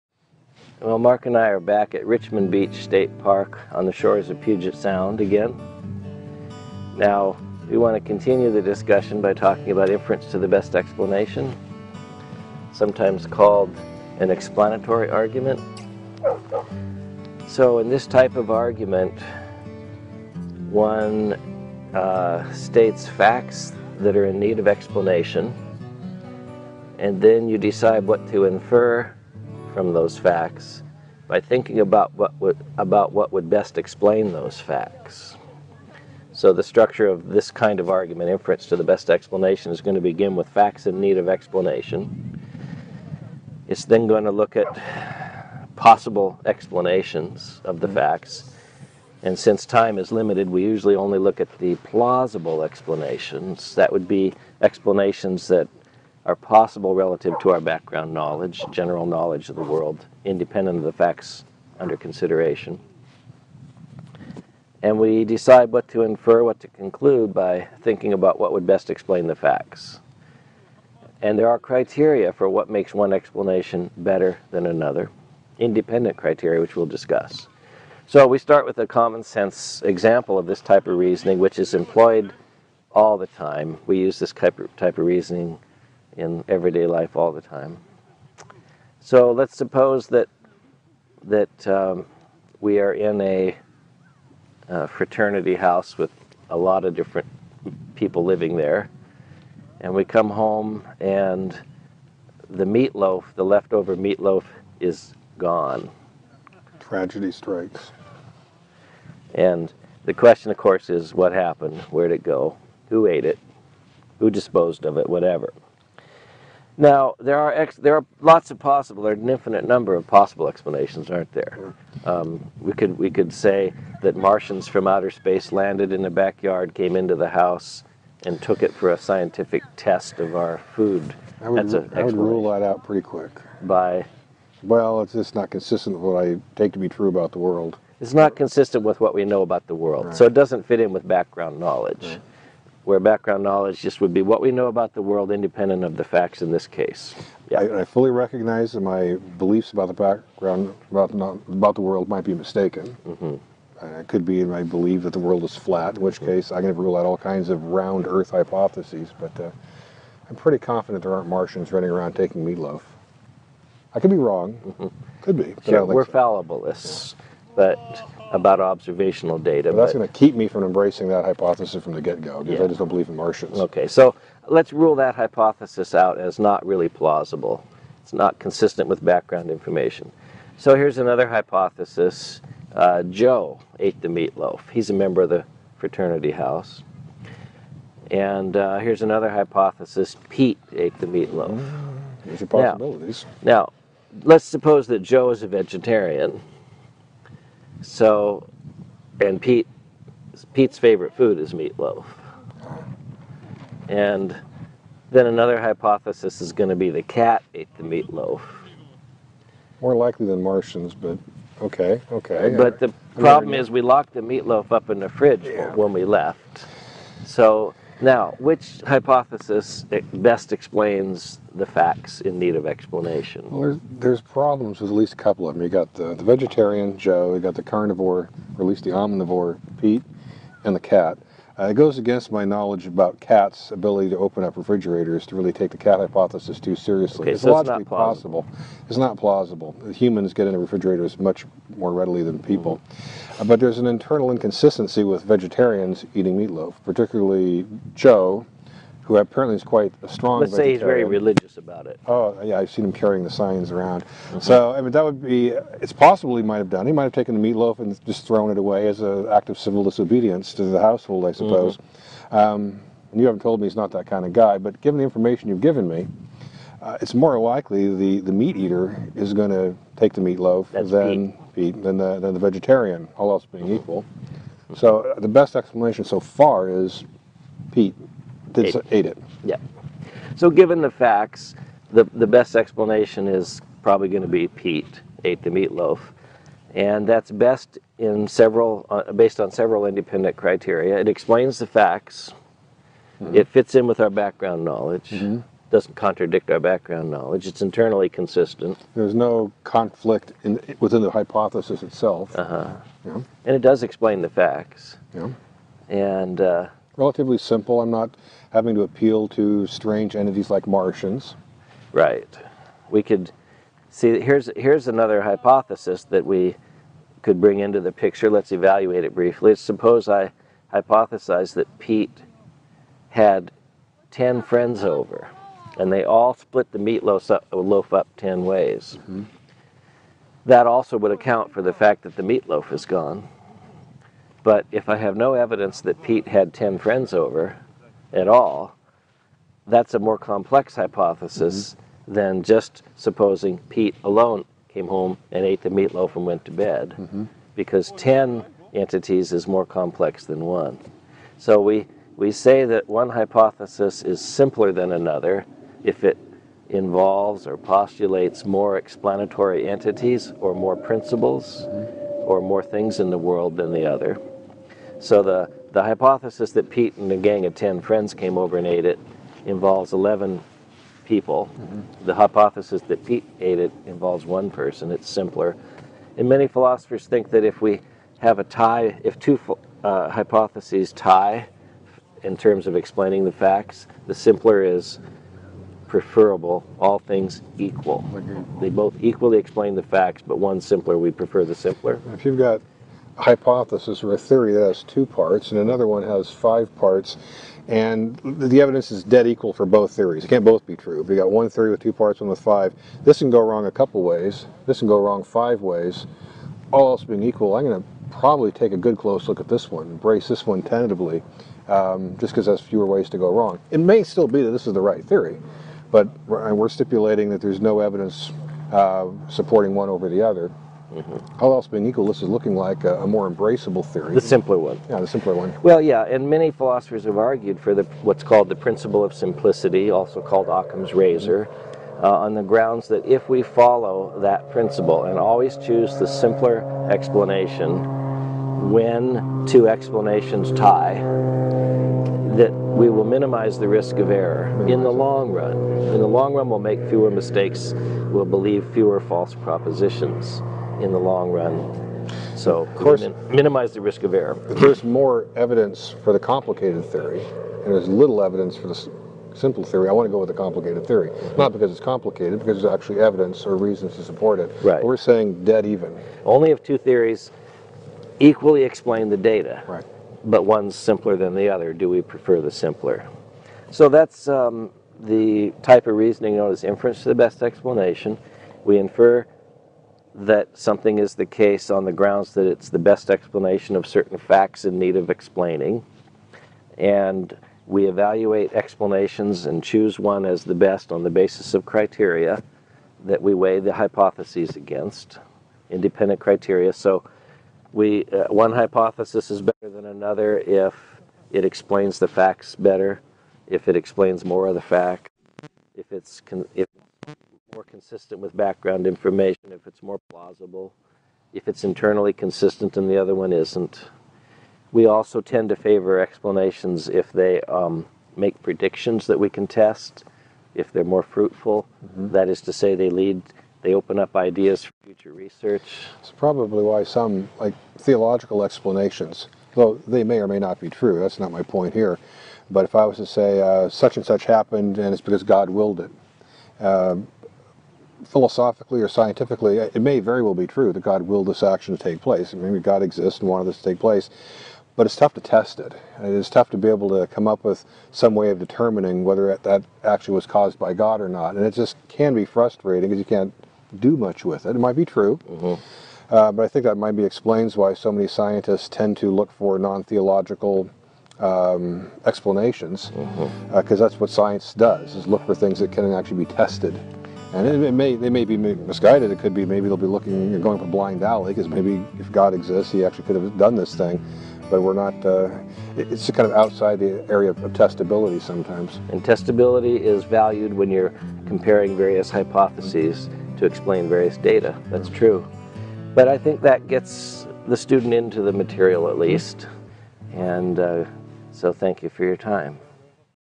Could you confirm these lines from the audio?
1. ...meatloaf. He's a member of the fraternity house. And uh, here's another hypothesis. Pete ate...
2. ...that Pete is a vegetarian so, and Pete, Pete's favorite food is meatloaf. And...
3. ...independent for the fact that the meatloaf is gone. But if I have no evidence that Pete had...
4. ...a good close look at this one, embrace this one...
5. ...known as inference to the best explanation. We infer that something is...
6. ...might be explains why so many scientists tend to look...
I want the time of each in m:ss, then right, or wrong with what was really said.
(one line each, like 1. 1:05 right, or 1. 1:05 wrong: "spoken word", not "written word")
1. 3:04 right
2. 3:14 wrong: "Joe", not "Pete"
3. 5:31 wrong: "account", not "independent"
4. 6:48 right
5. 7:56 right
6. 9:16 right.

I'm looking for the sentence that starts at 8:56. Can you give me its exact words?
Um, philosophically or scientifically, it may very well be true that God willed this action to take place.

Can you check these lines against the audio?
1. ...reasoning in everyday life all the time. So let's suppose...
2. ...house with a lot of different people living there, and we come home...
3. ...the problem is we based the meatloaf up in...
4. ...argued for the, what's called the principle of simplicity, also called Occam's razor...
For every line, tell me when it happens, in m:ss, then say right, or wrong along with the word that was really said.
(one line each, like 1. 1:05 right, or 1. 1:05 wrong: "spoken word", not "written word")
1. 1:25 right
2. 1:35 right
3. 3:32 wrong: "locked", not "based"
4. 7:07 right.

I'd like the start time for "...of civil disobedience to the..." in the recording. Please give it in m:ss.
4:19.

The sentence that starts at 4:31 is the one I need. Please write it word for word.
Pete than the than the vegetarian, all else being equal.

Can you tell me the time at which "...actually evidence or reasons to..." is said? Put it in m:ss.
7:42.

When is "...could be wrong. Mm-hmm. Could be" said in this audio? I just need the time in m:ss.
2:43.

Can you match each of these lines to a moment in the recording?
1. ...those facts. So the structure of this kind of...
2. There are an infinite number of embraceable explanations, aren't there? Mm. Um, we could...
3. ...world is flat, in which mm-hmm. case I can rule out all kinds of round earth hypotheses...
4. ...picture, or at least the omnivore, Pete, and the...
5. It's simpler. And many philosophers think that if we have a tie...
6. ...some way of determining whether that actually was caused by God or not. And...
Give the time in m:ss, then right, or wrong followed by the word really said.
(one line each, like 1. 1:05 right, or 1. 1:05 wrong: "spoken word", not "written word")
1. 0:34 right
2. 1:59 wrong: "possible", not "embraceable"
3. 2:35 right
4. 3:47 wrong: "carnivore", not "picture"
5. 6:14 right
6. 9:07 right.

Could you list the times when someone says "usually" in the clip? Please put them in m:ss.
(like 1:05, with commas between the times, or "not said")
0:50.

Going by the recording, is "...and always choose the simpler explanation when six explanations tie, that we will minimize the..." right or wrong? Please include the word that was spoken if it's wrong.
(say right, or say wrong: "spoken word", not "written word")
wrong: "two", not "six".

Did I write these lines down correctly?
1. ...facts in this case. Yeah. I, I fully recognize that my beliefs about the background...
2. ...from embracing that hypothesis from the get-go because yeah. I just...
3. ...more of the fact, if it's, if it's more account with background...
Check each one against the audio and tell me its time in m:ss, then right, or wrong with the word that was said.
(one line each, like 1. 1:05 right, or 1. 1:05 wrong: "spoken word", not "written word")
1. 2:26 right
2. 2:50 right
3. 8:24 wrong: "consistent", not "account".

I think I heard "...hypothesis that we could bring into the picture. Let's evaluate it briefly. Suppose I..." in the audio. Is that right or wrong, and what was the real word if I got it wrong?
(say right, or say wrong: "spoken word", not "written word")
right.